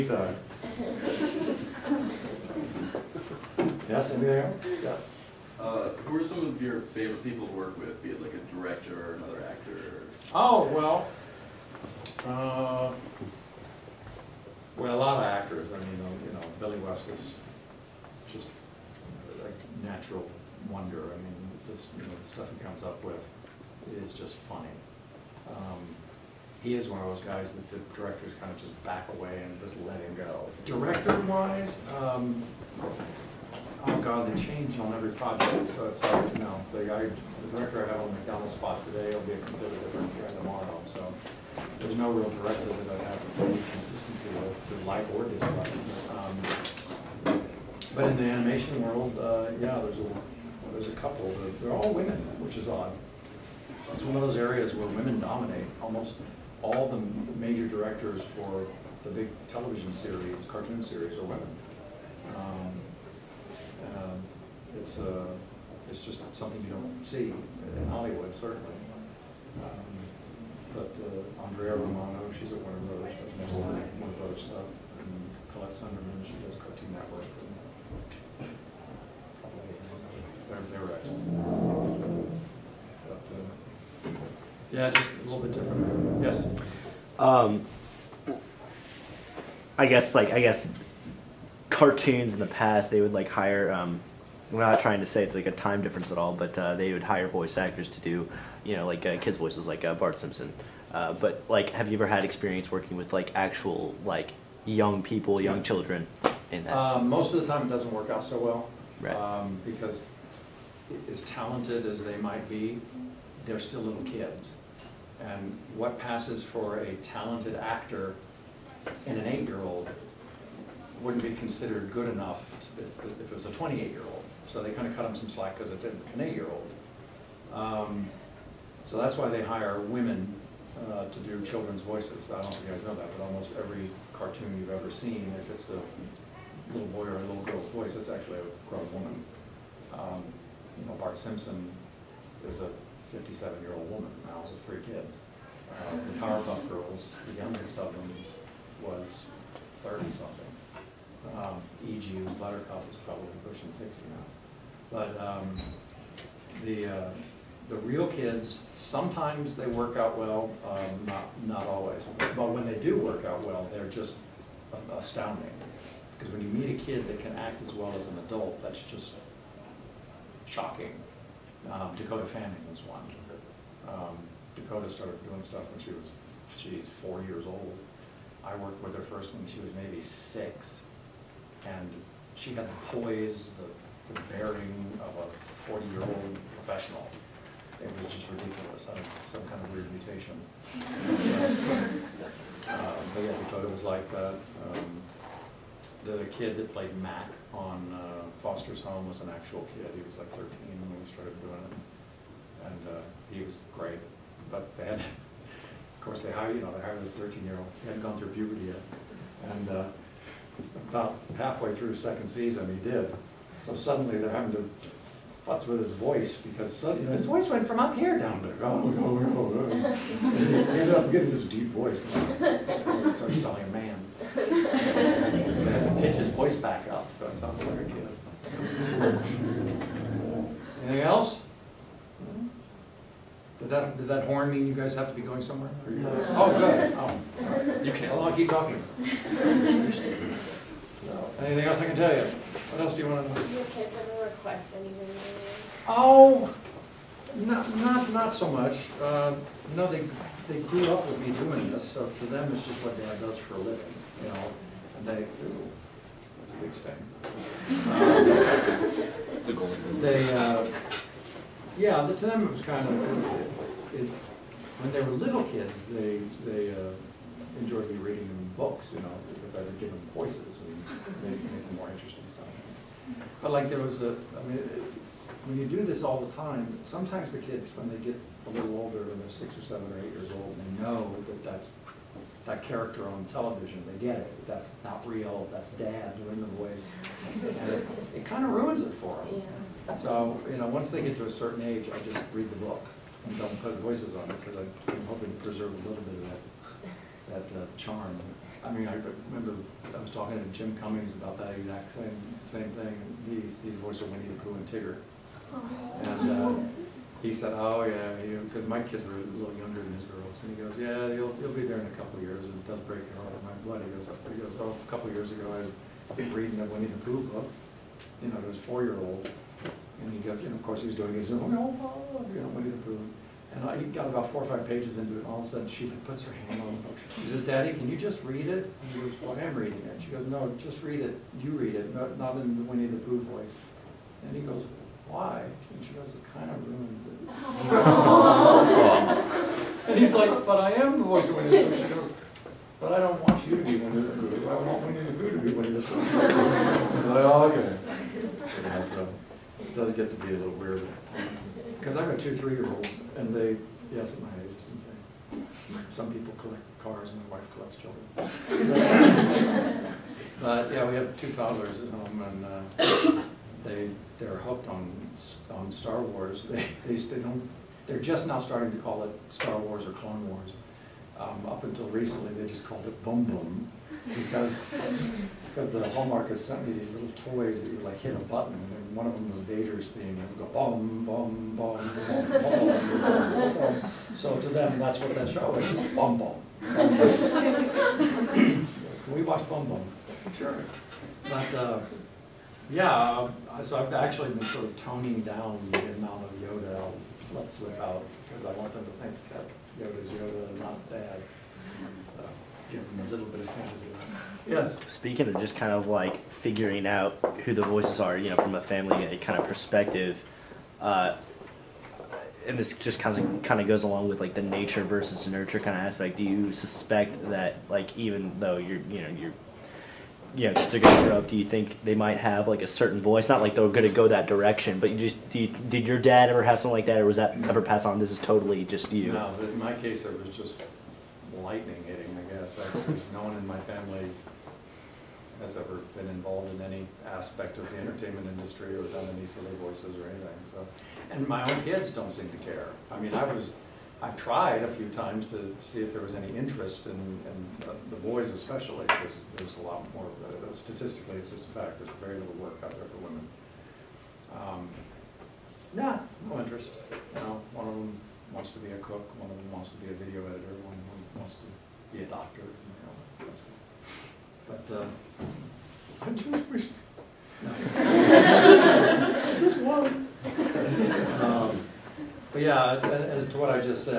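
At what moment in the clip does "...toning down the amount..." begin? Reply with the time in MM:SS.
06:34.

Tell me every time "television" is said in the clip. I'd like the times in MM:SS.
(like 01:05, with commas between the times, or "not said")
00:59, 04:43.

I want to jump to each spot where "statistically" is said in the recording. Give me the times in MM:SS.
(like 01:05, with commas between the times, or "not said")
07:30.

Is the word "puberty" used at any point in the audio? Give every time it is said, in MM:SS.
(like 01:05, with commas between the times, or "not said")
03:28.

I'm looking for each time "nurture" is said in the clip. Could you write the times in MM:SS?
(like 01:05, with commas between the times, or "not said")
06:55.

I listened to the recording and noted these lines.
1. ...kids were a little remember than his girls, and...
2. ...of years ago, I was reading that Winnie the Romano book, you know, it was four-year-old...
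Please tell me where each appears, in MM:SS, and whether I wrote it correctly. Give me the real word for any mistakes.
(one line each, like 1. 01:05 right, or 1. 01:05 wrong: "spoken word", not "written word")
1. 05:08 wrong: "younger", not "remember"
2. 05:15 wrong: "Pooh", not "Romano".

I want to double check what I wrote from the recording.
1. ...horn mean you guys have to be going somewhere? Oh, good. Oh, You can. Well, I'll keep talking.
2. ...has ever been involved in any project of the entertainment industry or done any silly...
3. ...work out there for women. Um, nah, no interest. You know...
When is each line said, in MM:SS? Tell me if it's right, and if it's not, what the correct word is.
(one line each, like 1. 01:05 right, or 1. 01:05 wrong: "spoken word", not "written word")
1. 03:54 right
2. 07:15 wrong: "aspect", not "project"
3. 07:32 right.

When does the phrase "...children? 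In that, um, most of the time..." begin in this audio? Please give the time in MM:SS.
01:45.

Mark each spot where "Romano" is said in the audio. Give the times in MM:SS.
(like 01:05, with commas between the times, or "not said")
01:11.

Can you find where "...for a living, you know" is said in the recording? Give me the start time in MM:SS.
04:13.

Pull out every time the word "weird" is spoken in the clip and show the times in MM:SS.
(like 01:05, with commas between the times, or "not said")
03:09, 05:50.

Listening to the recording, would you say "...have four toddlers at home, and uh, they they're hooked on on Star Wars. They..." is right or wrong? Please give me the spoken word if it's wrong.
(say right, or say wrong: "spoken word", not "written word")
wrong: "two", not "four".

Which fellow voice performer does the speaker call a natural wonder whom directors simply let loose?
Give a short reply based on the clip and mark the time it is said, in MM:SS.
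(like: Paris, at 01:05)
Billy West, at 00:16.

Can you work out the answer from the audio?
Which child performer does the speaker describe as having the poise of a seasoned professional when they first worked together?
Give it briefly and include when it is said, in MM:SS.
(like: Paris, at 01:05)
Dakota Fanning, at 02:51.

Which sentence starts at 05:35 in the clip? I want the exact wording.
And she goes, it kind of ruins it.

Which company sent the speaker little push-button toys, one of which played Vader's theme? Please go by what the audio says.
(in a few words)
Hallmark.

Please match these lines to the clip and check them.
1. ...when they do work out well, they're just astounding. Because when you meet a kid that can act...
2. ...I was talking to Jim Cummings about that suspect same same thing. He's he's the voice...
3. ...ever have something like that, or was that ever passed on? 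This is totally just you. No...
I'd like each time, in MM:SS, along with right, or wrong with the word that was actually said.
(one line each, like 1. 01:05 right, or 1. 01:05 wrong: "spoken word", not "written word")
1. 02:42 right
2. 04:59 wrong: "exact", not "suspect"
3. 07:06 right.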